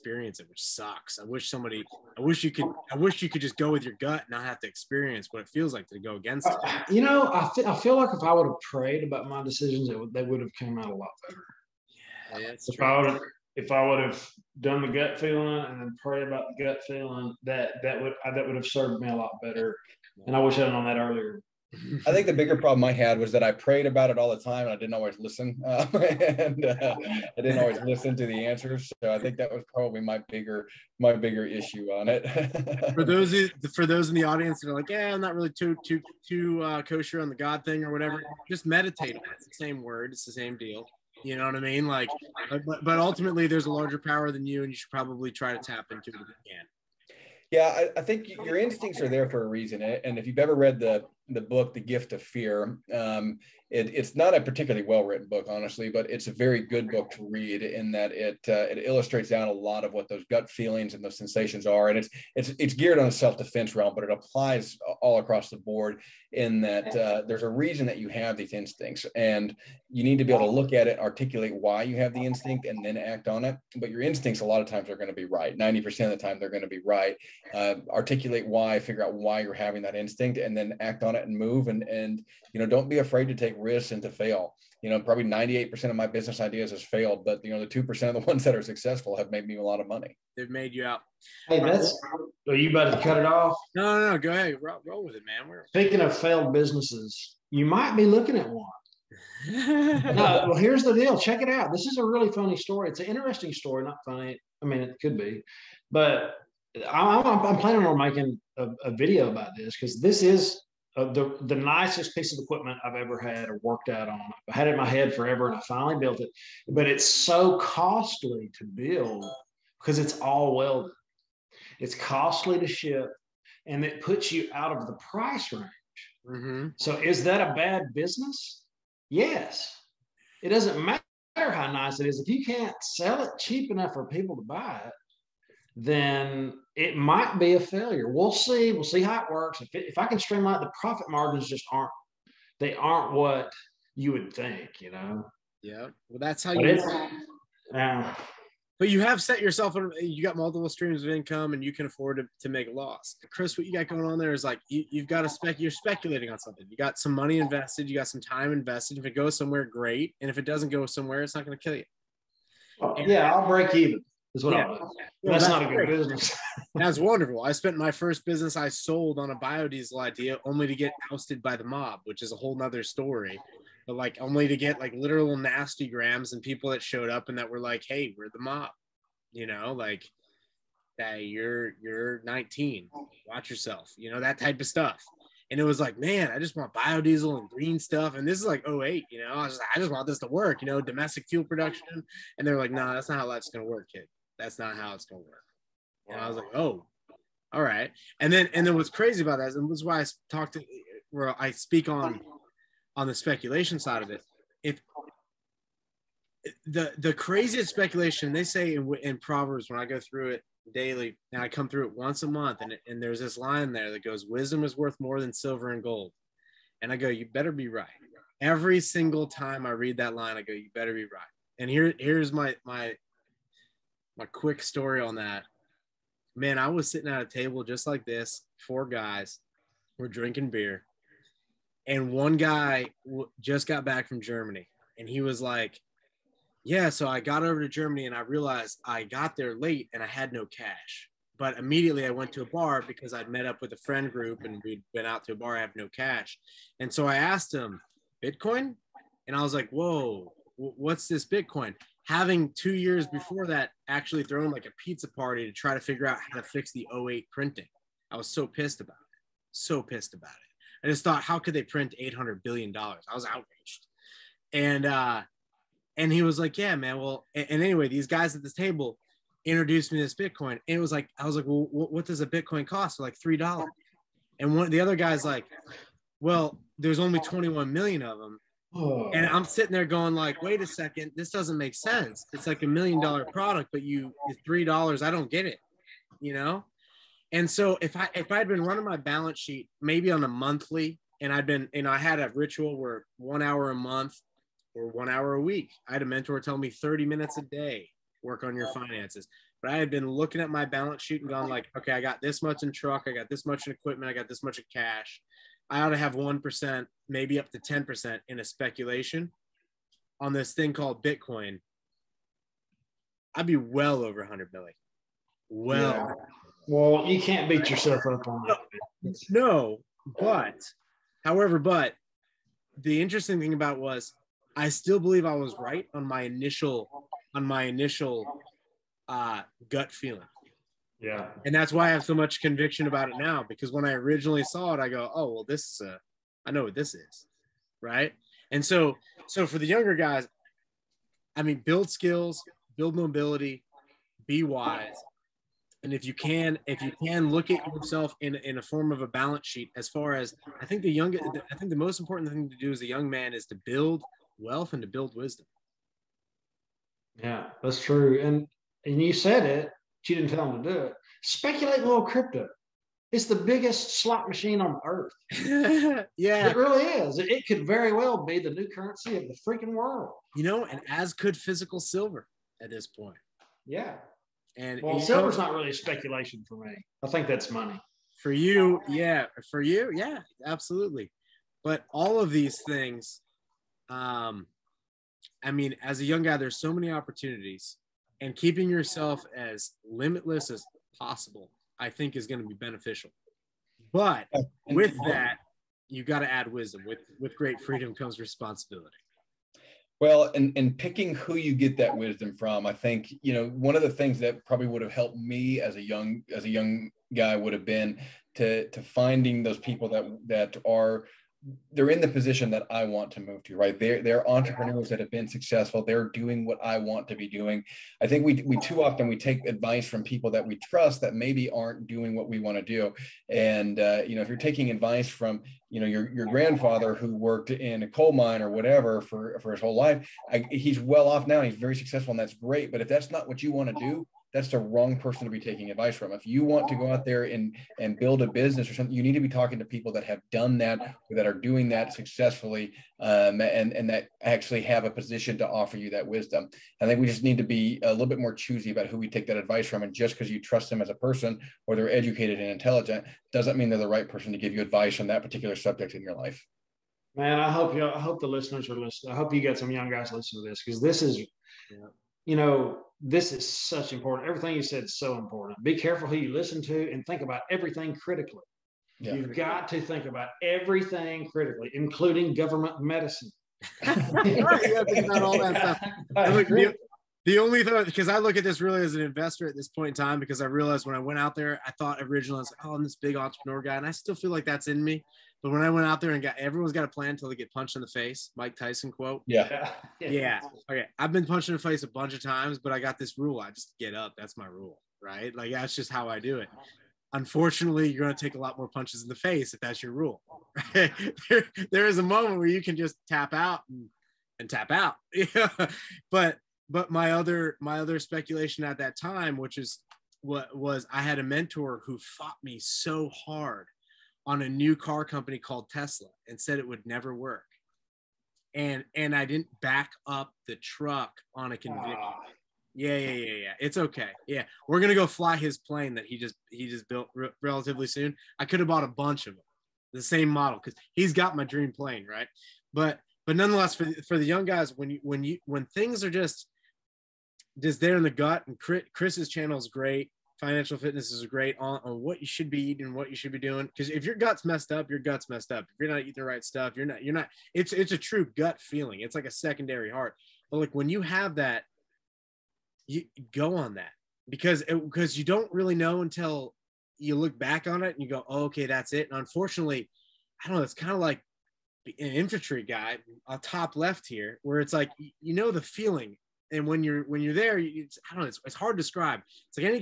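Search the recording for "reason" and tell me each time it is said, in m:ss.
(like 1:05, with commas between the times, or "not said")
0:49, 1:07.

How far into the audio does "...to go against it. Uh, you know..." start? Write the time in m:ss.
0:05.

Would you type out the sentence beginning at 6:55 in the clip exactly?
They're doing what I want to be doing.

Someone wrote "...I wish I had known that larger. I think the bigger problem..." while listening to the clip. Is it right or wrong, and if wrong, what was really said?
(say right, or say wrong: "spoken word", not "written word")
wrong: "earlier", not "larger".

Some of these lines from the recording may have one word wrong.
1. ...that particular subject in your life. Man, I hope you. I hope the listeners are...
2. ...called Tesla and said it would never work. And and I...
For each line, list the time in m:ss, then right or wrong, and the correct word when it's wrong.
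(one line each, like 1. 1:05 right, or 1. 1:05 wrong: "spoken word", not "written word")
1. 7:35 right
2. 8:35 right.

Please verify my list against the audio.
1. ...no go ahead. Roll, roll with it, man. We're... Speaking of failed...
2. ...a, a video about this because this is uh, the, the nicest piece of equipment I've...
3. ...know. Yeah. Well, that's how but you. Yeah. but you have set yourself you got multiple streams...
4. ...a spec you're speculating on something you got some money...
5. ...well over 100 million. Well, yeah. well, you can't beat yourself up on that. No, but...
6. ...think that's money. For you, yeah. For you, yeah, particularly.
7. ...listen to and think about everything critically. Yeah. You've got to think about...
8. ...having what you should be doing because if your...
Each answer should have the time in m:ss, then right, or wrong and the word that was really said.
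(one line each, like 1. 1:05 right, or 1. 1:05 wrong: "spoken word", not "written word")
1. 1:34 right
2. 1:48 right
3. 2:24 right
4. 2:35 right
5. 5:13 right
6. 6:17 wrong: "absolutely", not "particularly"
7. 7:46 right
8. 9:02 wrong: "eating", not "having".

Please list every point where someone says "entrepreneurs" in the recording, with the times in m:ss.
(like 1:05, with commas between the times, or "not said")
6:54, 8:03.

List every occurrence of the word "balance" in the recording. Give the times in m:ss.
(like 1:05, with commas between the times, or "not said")
4:48, 5:00, 5:49.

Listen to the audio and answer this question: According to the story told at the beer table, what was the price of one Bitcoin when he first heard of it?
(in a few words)
$3.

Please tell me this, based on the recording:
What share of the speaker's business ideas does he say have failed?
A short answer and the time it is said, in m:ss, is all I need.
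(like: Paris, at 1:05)
98%, at 1:25.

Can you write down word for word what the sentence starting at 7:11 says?
He's very successful, and that's great.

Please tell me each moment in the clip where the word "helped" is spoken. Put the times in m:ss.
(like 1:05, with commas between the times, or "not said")
6:44.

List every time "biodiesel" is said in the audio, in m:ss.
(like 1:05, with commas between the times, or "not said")
2:49, 3:06.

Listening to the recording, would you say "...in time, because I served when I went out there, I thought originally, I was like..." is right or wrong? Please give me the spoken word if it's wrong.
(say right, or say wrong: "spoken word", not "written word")
wrong: "realized", not "served".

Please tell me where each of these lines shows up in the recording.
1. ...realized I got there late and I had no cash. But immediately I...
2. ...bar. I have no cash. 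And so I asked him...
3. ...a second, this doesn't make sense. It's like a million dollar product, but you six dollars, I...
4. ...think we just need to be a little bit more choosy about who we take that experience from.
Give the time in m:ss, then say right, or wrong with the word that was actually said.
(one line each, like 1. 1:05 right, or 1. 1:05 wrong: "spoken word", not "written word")
1. 3:58 right
2. 4:05 right
3. 4:40 wrong: "three", not "six"
4. 7:26 wrong: "advice", not "experience".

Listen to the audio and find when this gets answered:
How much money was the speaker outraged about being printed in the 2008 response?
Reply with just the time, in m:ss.
4:21.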